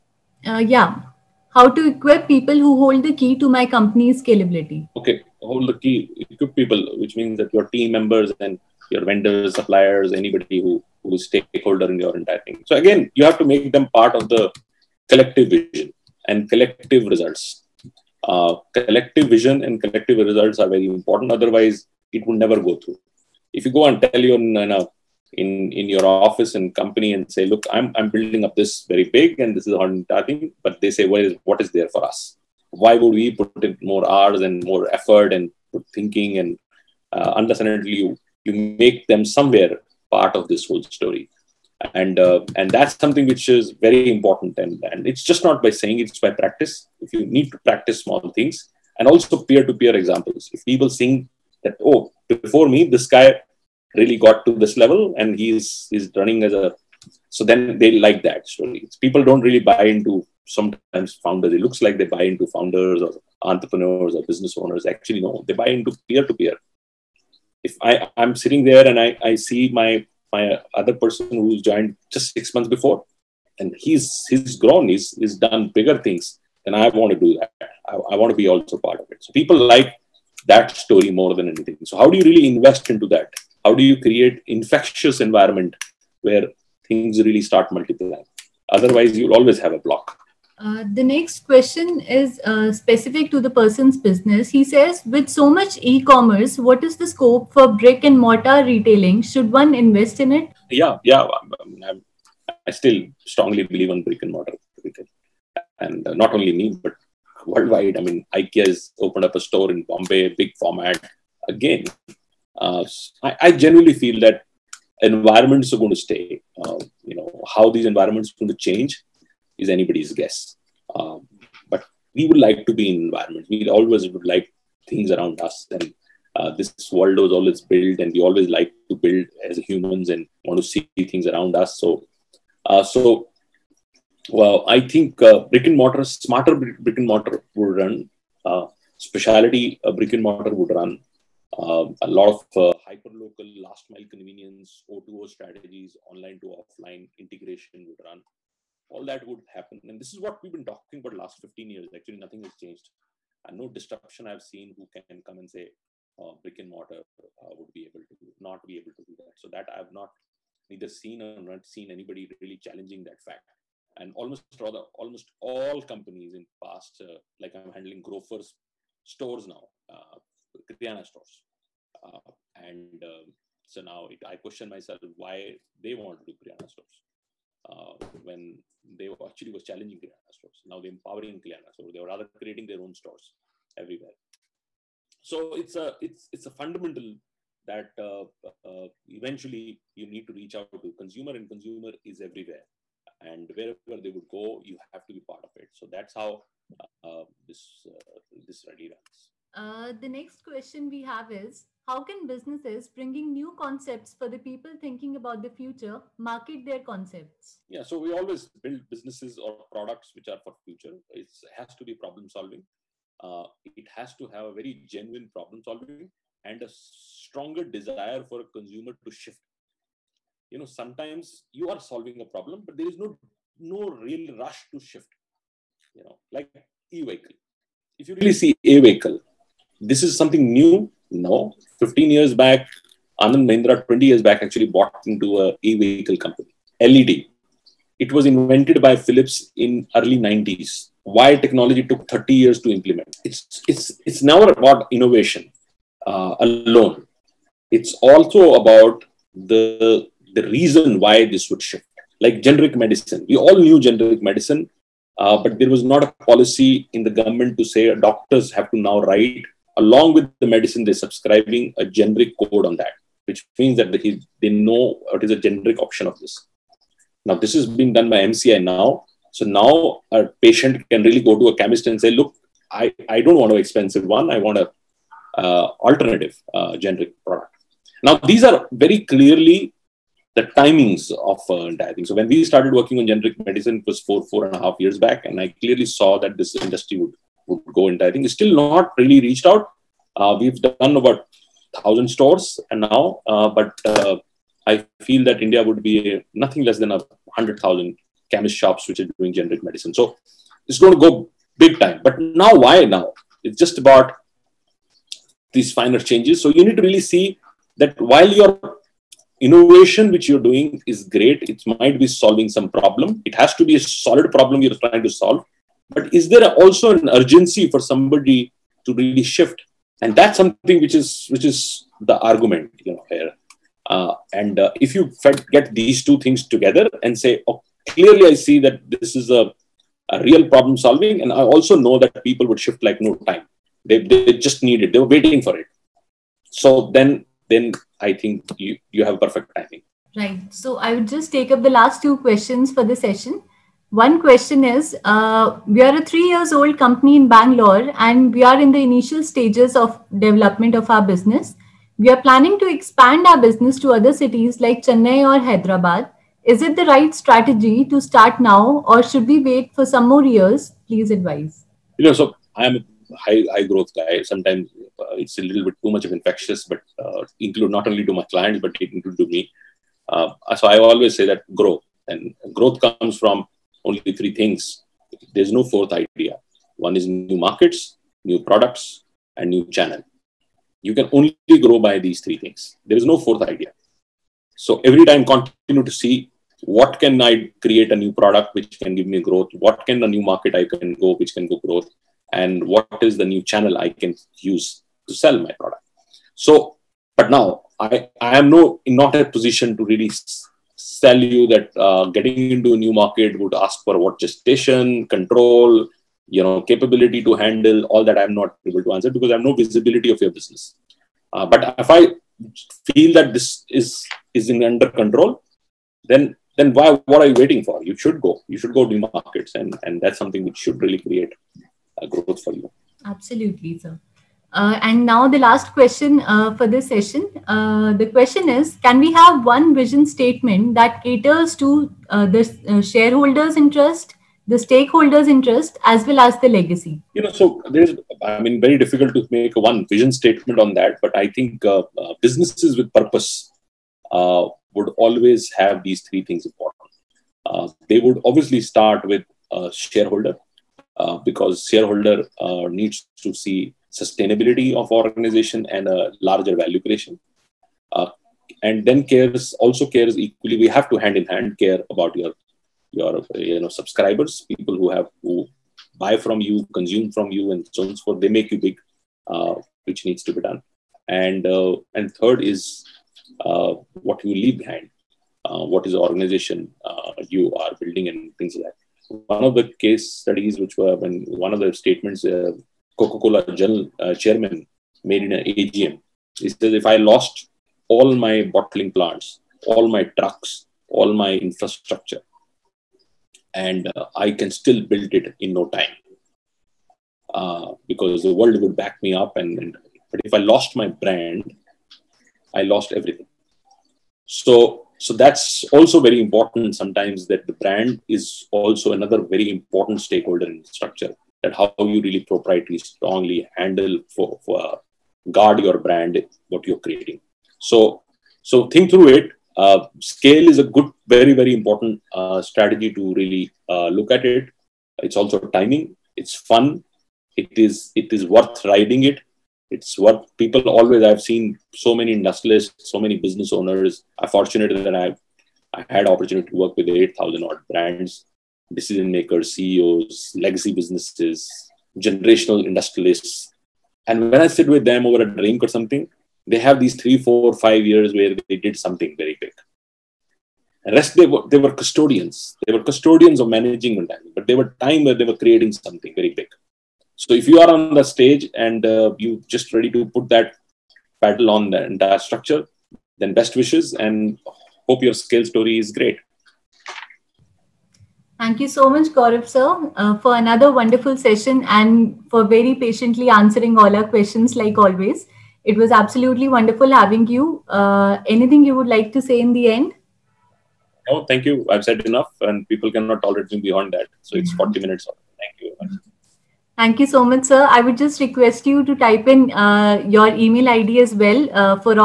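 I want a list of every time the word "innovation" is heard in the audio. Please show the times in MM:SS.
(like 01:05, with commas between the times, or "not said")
04:04, 05:09.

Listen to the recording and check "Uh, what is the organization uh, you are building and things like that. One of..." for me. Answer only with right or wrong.
right.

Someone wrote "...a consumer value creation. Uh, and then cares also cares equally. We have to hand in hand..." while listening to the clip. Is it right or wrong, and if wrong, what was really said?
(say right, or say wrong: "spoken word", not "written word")
wrong: "larger", not "consumer".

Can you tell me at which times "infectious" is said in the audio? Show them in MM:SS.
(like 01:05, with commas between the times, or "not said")
01:24, 06:06.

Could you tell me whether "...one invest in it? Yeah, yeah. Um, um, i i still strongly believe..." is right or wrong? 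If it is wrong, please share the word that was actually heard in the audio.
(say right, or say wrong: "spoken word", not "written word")
right.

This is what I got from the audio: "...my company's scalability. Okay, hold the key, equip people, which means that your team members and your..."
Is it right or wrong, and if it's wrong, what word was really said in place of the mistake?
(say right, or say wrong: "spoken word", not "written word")
right.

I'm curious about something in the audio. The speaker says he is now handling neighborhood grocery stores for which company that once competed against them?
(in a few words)
Grofers.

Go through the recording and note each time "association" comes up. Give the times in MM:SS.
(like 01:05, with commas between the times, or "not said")
not said.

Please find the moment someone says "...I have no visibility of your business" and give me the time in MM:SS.
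06:49.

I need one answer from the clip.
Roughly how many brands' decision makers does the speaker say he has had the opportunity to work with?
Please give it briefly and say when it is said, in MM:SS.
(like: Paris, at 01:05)
8000, at 08:56.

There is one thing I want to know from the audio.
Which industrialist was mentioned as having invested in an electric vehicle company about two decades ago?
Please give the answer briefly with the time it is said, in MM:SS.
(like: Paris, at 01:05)
Anand Mahindra, at 03:53.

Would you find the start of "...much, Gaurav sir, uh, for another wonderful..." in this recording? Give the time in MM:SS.
09:28.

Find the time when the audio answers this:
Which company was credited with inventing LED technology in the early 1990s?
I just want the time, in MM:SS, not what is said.
03:58.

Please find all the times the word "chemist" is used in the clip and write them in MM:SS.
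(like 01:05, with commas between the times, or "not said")
04:31, 04:58.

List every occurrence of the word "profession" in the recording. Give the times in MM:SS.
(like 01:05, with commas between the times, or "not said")
not said.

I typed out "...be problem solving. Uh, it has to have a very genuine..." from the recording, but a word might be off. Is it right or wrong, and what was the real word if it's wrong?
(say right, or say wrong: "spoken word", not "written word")
right.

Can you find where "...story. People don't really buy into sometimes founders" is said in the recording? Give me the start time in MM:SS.
00:58.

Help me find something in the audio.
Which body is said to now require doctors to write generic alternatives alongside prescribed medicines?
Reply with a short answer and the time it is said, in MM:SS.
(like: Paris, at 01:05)
MCI, at 04:28.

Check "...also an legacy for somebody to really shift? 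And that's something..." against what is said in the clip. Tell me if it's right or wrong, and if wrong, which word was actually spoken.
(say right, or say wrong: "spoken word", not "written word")
wrong: "urgency", not "legacy".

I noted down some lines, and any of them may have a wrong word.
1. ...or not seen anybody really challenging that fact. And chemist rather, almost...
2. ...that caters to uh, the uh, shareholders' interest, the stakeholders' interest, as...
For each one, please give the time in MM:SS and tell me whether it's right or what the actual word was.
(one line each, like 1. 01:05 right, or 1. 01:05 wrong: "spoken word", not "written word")
1. 02:41 wrong: "almost", not "chemist"
2. 07:10 right.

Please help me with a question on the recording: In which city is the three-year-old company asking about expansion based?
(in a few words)
Bangalore.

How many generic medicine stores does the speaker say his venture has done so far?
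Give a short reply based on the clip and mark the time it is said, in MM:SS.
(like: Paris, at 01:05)
1000, at 04:51.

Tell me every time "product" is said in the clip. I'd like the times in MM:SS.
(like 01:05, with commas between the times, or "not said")
03:29, 04:37, 06:18, 06:28, 06:35.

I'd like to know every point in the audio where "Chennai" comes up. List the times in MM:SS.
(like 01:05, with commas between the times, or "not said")
05:54.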